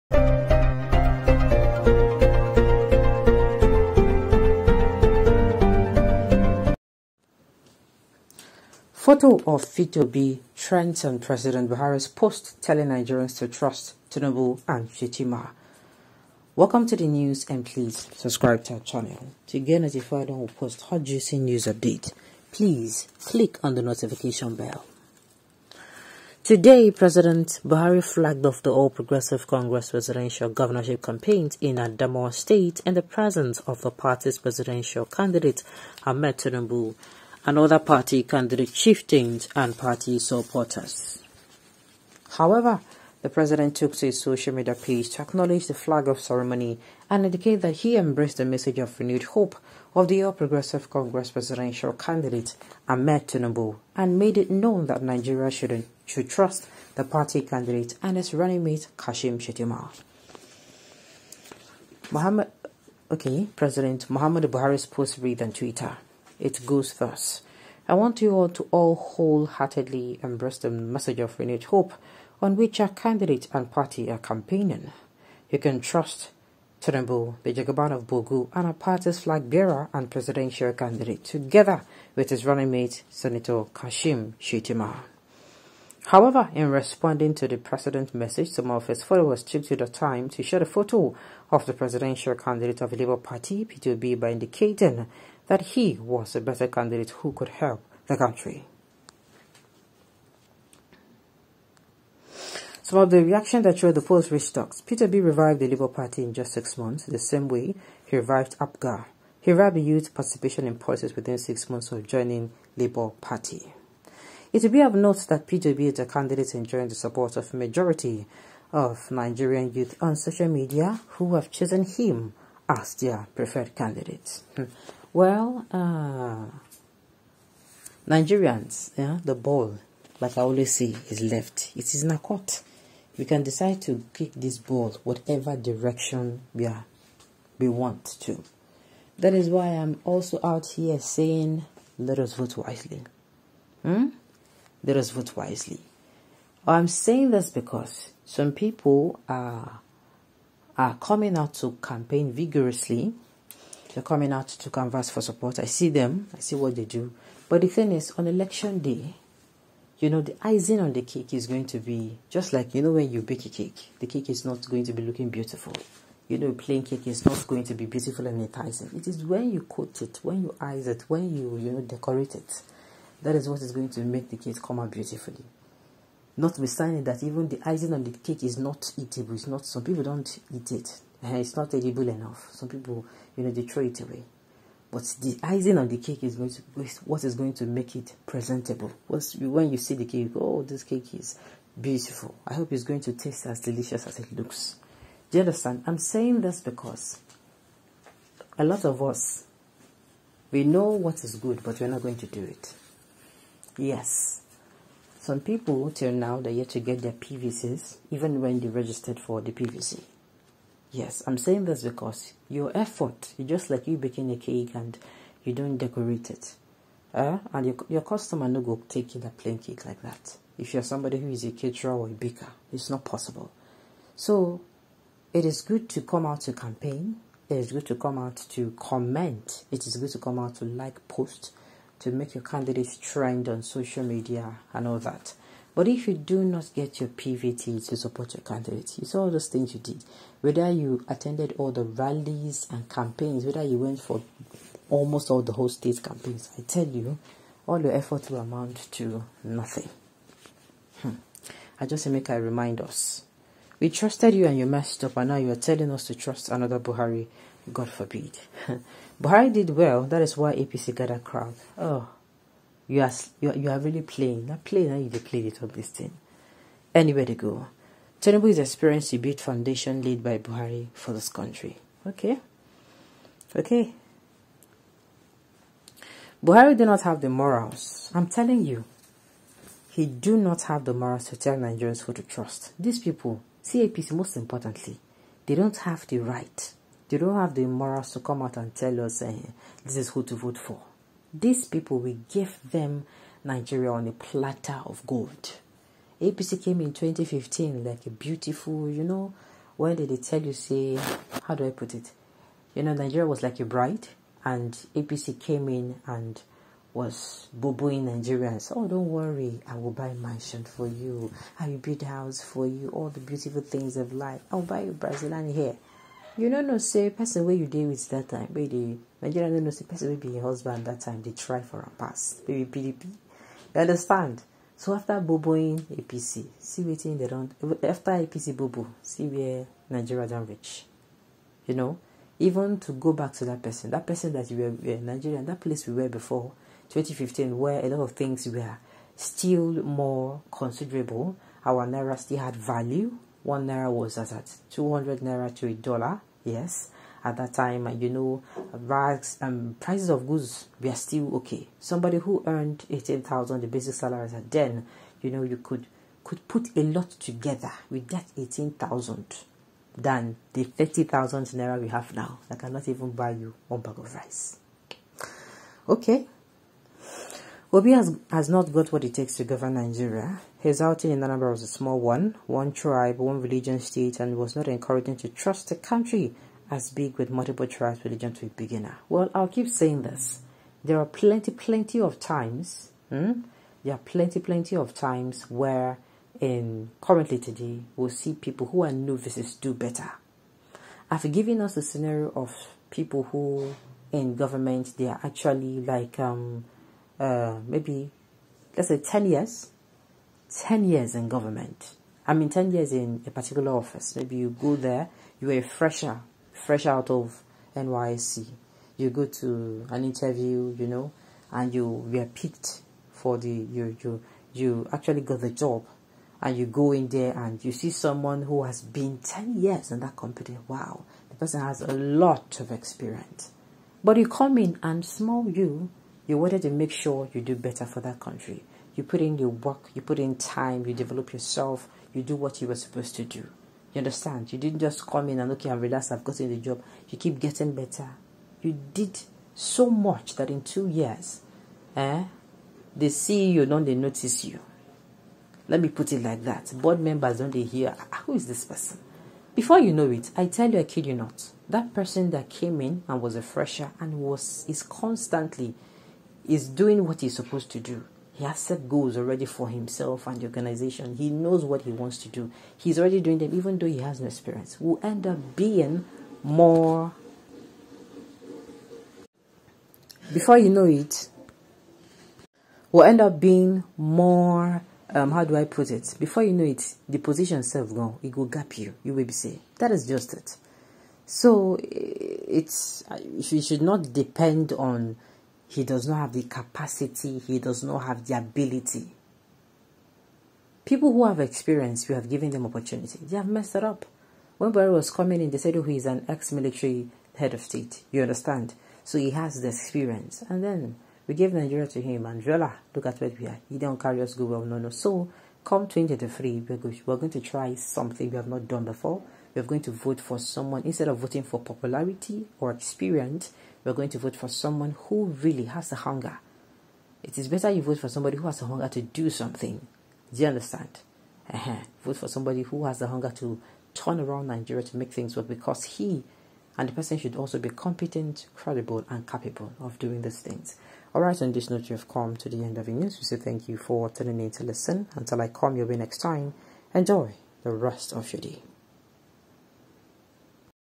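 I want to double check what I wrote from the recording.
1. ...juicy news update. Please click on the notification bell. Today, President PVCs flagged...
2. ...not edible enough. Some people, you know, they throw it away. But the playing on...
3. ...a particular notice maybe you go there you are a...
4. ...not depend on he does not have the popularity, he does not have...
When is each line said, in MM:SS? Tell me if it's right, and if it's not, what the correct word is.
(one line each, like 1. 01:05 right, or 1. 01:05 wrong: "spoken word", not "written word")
1. 00:21 wrong: "Buhari", not "PVCs"
2. 03:01 wrong: "icing", not "playing"
3. 06:43 wrong: "office", not "notice"
4. 08:03 wrong: "capacity", not "popularity".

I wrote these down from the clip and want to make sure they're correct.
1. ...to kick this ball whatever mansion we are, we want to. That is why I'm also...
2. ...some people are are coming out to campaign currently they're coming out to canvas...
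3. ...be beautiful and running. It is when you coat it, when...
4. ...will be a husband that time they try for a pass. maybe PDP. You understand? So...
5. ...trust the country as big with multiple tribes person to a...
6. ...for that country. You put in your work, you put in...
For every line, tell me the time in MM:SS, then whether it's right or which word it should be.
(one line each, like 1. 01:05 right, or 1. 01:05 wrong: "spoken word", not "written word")
1. 02:13 wrong: "direction", not "mansion"
2. 02:28 wrong: "vigorously", not "currently"
3. 02:47 wrong: "enticing", not "running"
4. 05:20 right
5. 06:15 wrong: "religion", not "person"
6. 07:07 right.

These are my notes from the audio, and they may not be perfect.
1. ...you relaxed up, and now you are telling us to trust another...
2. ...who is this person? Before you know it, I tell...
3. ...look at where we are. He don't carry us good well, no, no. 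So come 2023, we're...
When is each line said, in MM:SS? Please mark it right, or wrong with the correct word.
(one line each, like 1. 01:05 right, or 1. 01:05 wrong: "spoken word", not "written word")
1. 04:14 wrong: "messed", not "relaxed"
2. 07:28 right
3. 08:22 right.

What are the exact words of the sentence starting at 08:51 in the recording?
All right, on this note, you have come to the end of the news.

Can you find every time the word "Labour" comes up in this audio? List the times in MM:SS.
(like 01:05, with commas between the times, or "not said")
01:32, 01:45, 01:52.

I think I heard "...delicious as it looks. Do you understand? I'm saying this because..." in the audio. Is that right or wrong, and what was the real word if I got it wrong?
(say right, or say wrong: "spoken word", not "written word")
right.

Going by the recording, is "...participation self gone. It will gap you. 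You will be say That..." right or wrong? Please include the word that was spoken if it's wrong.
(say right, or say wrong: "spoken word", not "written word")
wrong: "position", not "participation".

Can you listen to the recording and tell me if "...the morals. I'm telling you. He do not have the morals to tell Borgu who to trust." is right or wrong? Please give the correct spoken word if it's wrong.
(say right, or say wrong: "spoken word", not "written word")
wrong: "Nigerians", not "Borgu".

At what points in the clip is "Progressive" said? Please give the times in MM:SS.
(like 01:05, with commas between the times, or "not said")
00:28, 00:50.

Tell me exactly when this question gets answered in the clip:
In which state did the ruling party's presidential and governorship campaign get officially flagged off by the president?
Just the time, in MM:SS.
00:31.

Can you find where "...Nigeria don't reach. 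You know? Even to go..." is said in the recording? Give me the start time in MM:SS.
05:29.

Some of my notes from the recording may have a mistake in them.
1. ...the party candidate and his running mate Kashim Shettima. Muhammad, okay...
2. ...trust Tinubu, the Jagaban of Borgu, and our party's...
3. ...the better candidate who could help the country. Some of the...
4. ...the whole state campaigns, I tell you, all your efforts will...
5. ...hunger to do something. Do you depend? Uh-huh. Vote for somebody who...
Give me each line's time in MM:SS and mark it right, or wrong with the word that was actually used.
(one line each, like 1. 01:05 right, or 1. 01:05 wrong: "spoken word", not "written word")
1. 00:56 right
2. 01:15 right
3. 01:36 right
4. 04:05 right
5. 08:38 wrong: "understand", not "depend".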